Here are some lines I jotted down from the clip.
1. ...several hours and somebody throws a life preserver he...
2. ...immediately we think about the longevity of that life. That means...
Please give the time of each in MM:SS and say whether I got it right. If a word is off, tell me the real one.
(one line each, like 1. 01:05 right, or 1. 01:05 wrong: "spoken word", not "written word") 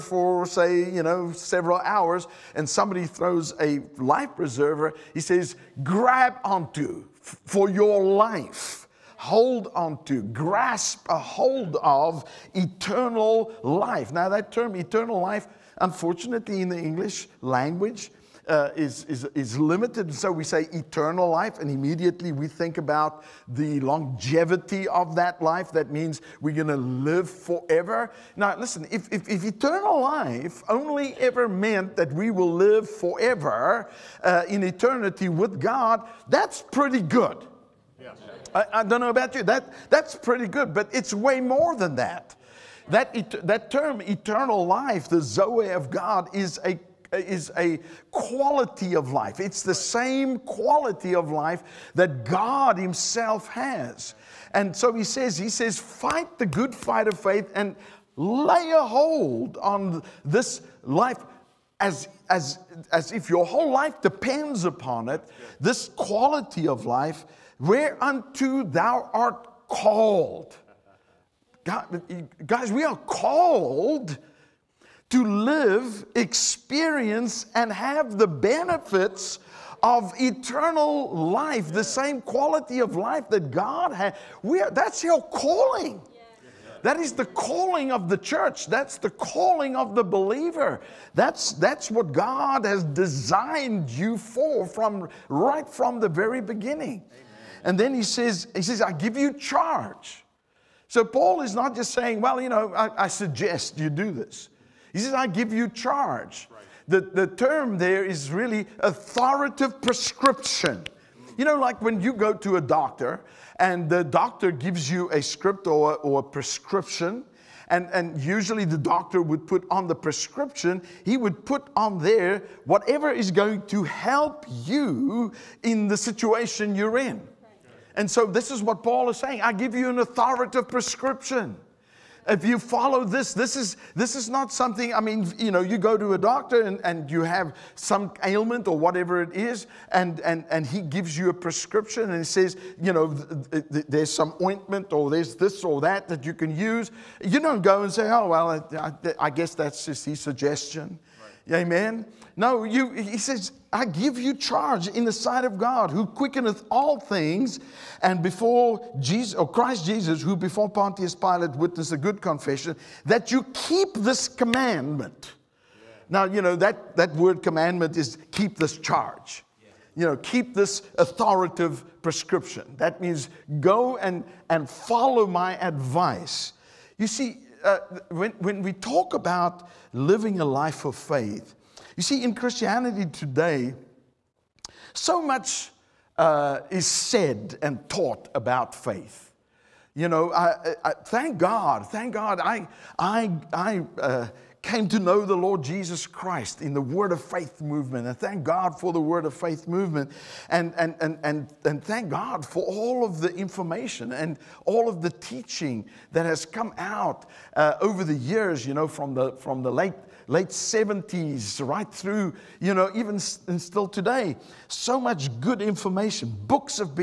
1. 00:01 right
2. 00:21 right.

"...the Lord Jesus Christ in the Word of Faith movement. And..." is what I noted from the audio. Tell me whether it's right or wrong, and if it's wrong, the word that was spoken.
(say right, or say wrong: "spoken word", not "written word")
right.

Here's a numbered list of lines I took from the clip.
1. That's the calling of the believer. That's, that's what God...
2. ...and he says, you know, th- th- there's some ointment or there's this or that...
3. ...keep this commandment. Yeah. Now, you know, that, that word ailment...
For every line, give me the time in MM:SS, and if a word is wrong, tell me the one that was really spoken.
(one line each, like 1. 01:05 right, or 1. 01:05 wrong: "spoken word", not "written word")
1. 01:28 right
2. 02:22 right
3. 02:43 wrong: "commandment", not "ailment".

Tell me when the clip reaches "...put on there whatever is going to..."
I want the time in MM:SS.
02:01.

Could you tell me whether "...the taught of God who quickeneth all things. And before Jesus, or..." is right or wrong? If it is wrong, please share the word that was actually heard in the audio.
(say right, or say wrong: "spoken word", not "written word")
wrong: "sight", not "taught".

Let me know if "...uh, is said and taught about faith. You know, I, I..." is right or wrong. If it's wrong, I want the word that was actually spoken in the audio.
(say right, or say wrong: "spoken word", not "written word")
right.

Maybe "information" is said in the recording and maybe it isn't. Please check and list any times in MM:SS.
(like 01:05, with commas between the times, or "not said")
03:23, 03:35.